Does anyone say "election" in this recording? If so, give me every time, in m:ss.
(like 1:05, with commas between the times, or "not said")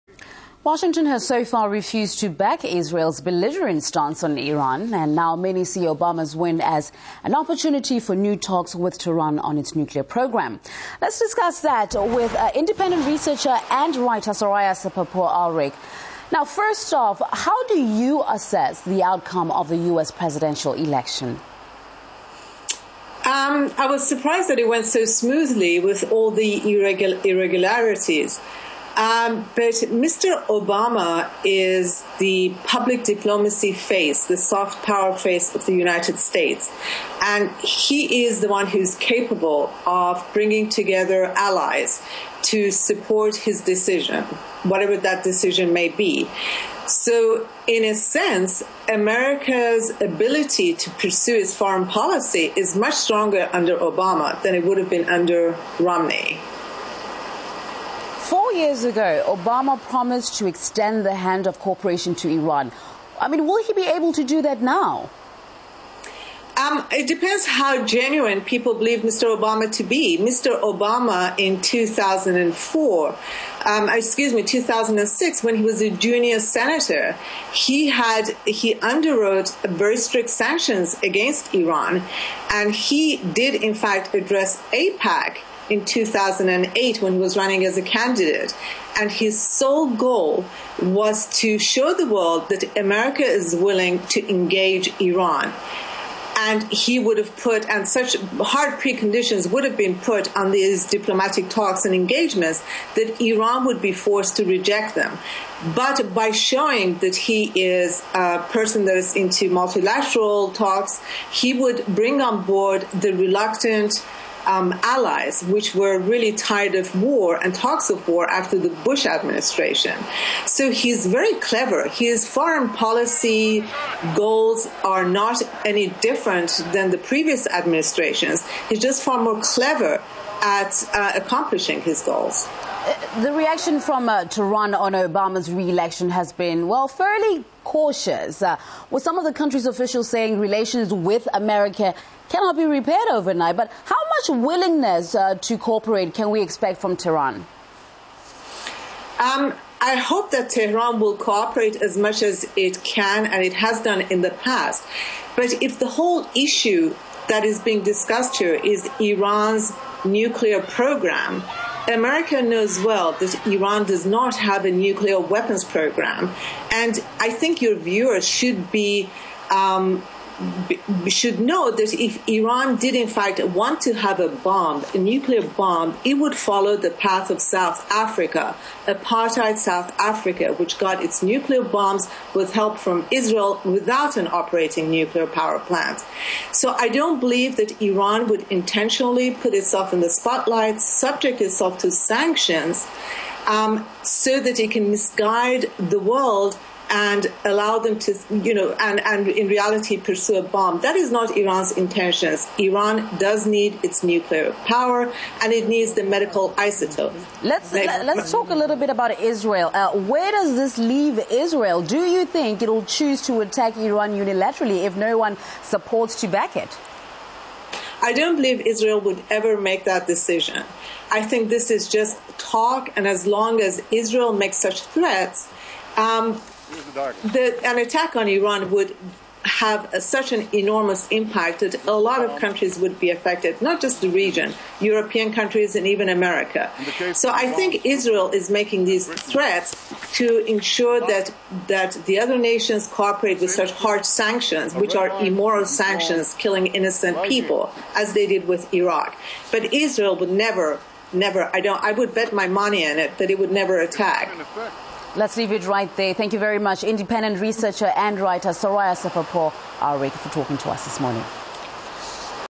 0:20, 2:15.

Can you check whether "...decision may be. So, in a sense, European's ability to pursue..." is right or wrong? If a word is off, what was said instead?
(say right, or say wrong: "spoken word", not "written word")
wrong: "America", not "European".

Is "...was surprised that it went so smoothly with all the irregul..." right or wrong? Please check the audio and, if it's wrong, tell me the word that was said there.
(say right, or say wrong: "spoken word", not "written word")
right.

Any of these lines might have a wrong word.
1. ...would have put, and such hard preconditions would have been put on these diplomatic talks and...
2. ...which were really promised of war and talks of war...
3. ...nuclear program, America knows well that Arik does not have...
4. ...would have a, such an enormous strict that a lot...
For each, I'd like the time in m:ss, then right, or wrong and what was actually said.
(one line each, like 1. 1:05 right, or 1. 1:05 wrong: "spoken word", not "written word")
1. 1:36 right
2. 1:55 wrong: "tired", not "promised"
3. 2:40 wrong: "Iran", not "Arik"
4. 3:48 wrong: "impact", not "strict".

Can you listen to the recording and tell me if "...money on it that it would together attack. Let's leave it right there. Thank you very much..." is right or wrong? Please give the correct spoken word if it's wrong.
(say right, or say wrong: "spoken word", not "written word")
wrong: "never", not "together".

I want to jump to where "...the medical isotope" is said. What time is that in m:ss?
3:25.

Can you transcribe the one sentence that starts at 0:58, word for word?
Four years ago, Obama promised to extend the hand of cooperation to Iran.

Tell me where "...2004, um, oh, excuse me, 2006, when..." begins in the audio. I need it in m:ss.
1:11.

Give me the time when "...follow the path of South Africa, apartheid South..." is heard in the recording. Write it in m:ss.
2:56.